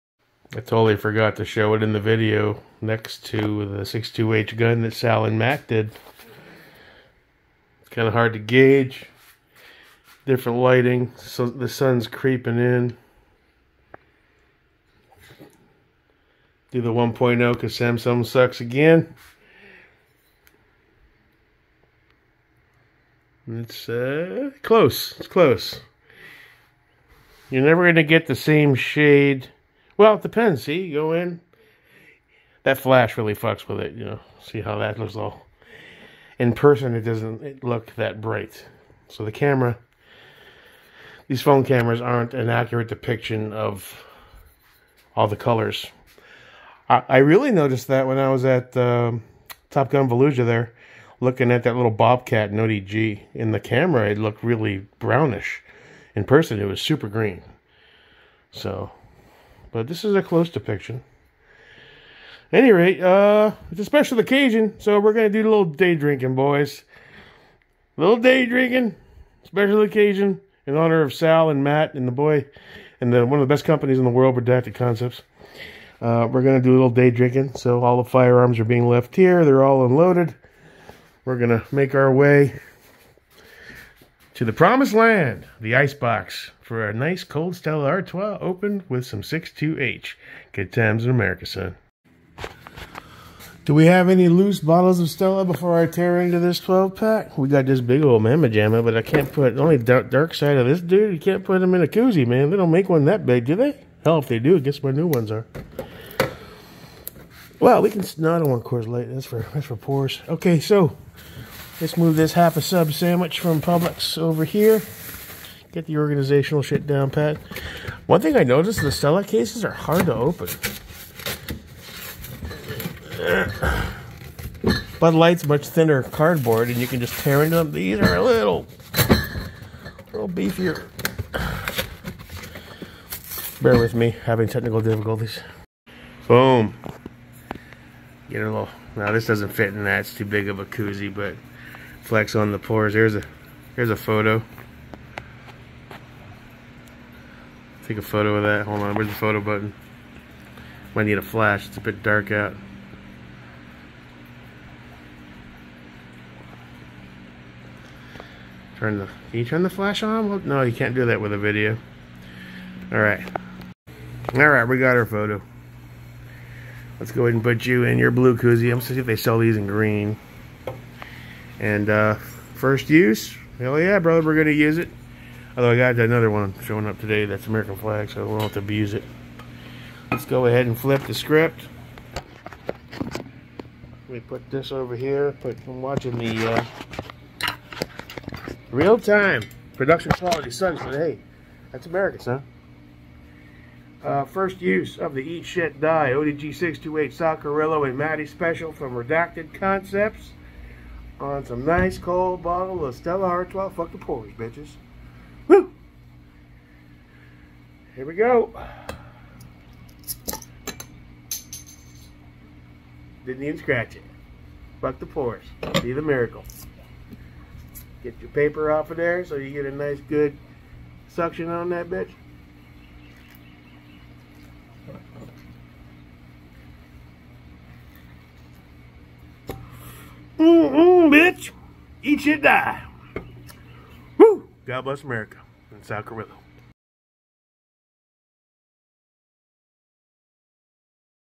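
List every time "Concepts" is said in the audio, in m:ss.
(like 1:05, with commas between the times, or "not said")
1:14, 3:19.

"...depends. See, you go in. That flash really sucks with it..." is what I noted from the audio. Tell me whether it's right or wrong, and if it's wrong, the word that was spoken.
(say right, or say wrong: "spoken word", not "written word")
wrong: "fucks", not "sucks".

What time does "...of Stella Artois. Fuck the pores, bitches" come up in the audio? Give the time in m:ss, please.
3:22.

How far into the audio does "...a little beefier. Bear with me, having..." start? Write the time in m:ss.
2:08.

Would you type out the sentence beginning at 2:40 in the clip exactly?
Well, no, you can't do that with a video.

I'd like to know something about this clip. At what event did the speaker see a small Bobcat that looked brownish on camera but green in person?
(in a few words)
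Top Gun Volusia.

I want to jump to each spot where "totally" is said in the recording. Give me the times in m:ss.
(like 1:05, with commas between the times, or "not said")
0:00.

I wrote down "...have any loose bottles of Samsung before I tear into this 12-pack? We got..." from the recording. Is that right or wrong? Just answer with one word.
wrong.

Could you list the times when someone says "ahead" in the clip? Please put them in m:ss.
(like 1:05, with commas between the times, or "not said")
2:47, 3:00.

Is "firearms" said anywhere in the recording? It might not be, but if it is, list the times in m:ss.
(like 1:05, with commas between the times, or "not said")
1:18.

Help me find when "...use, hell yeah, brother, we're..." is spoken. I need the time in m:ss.
2:52.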